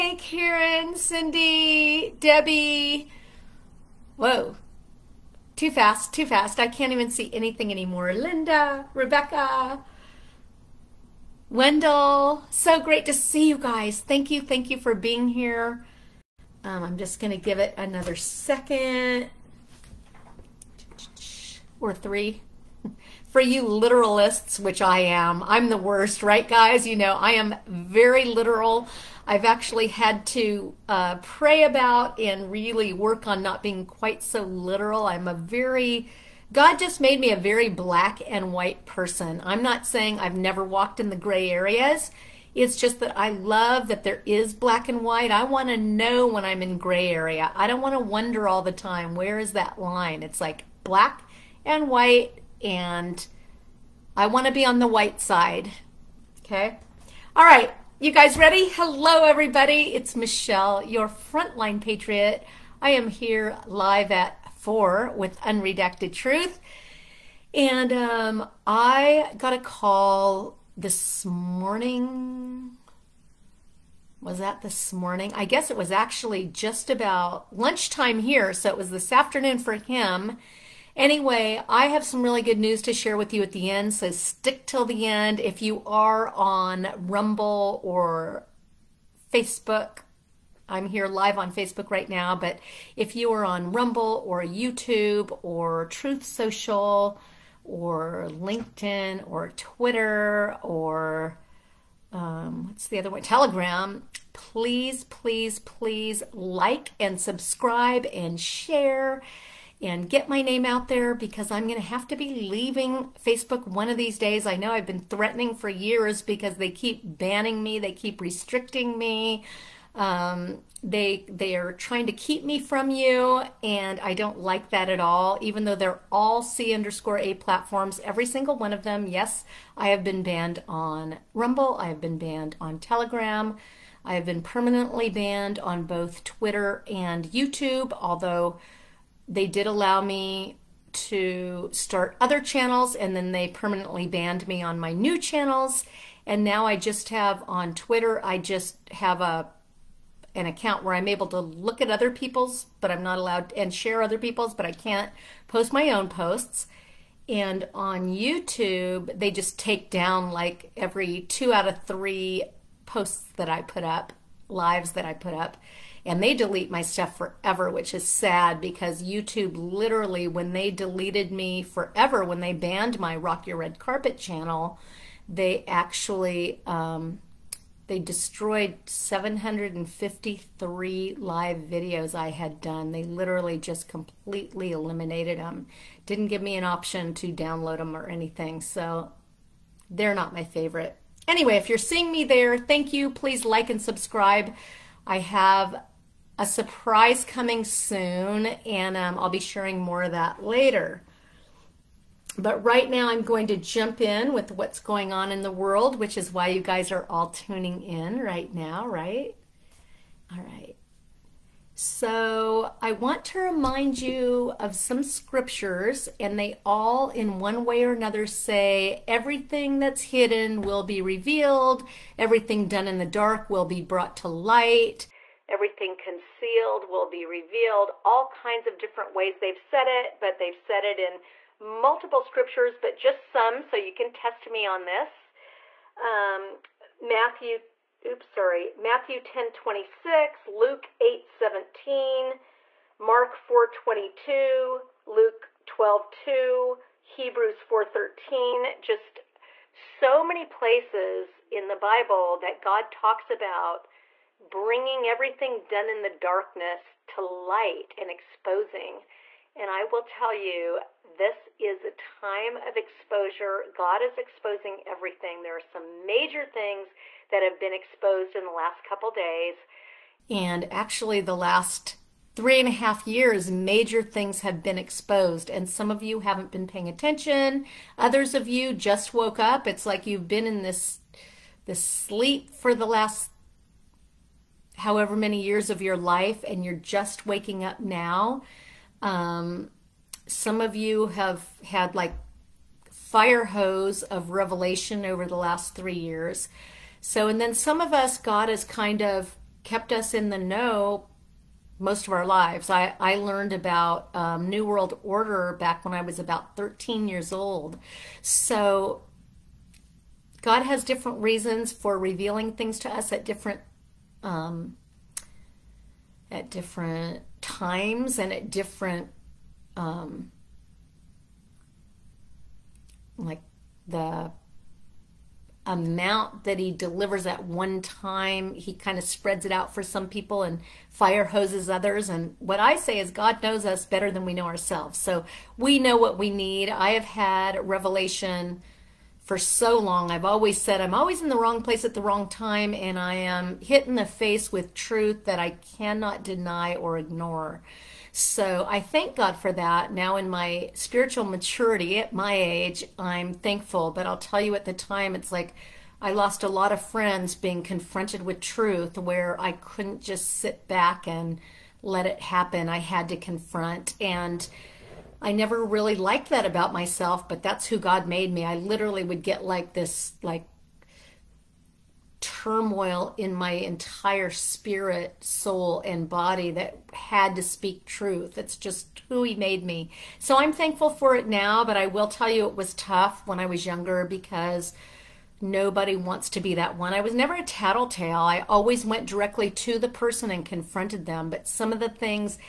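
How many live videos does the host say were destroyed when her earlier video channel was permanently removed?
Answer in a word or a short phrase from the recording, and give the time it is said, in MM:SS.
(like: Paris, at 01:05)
753, at 02:58.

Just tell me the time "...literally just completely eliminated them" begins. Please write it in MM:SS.
03:03.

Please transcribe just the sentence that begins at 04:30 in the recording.
And actually, the last three and a half years, major things have been exposed.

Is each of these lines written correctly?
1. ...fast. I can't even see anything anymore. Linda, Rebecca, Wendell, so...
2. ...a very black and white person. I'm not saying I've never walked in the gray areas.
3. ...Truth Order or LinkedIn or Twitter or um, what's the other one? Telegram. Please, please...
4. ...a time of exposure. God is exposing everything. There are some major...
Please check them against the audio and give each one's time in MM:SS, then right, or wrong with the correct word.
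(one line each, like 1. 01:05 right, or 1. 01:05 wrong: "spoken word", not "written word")
1. 00:06 right
2. 00:37 right
3. 01:35 wrong: "Social", not "Order"
4. 04:21 right.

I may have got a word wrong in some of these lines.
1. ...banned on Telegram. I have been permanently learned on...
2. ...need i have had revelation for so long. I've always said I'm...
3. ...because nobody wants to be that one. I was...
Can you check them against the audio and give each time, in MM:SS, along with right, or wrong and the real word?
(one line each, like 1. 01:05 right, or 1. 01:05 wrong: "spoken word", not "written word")
1. 02:12 wrong: "banned", not "learned"
2. 05:36 right
3. 06:24 right.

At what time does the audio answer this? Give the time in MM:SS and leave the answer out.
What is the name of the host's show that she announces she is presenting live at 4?
01:05.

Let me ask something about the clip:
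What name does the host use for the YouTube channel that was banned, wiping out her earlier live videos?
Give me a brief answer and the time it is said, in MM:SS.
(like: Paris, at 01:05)
Rock Your Red Carpet, at 02:53.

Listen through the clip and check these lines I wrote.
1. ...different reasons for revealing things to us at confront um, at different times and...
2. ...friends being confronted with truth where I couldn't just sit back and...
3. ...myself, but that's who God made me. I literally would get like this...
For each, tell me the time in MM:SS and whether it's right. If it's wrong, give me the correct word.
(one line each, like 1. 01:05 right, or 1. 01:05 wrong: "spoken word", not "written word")
1. 05:10 wrong: "different", not "confront"
2. 05:56 right
3. 06:06 right.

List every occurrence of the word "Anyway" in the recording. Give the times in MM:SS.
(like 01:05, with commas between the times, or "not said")
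01:20, 03:11.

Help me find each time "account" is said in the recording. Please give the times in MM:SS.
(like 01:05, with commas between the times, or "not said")
02:30.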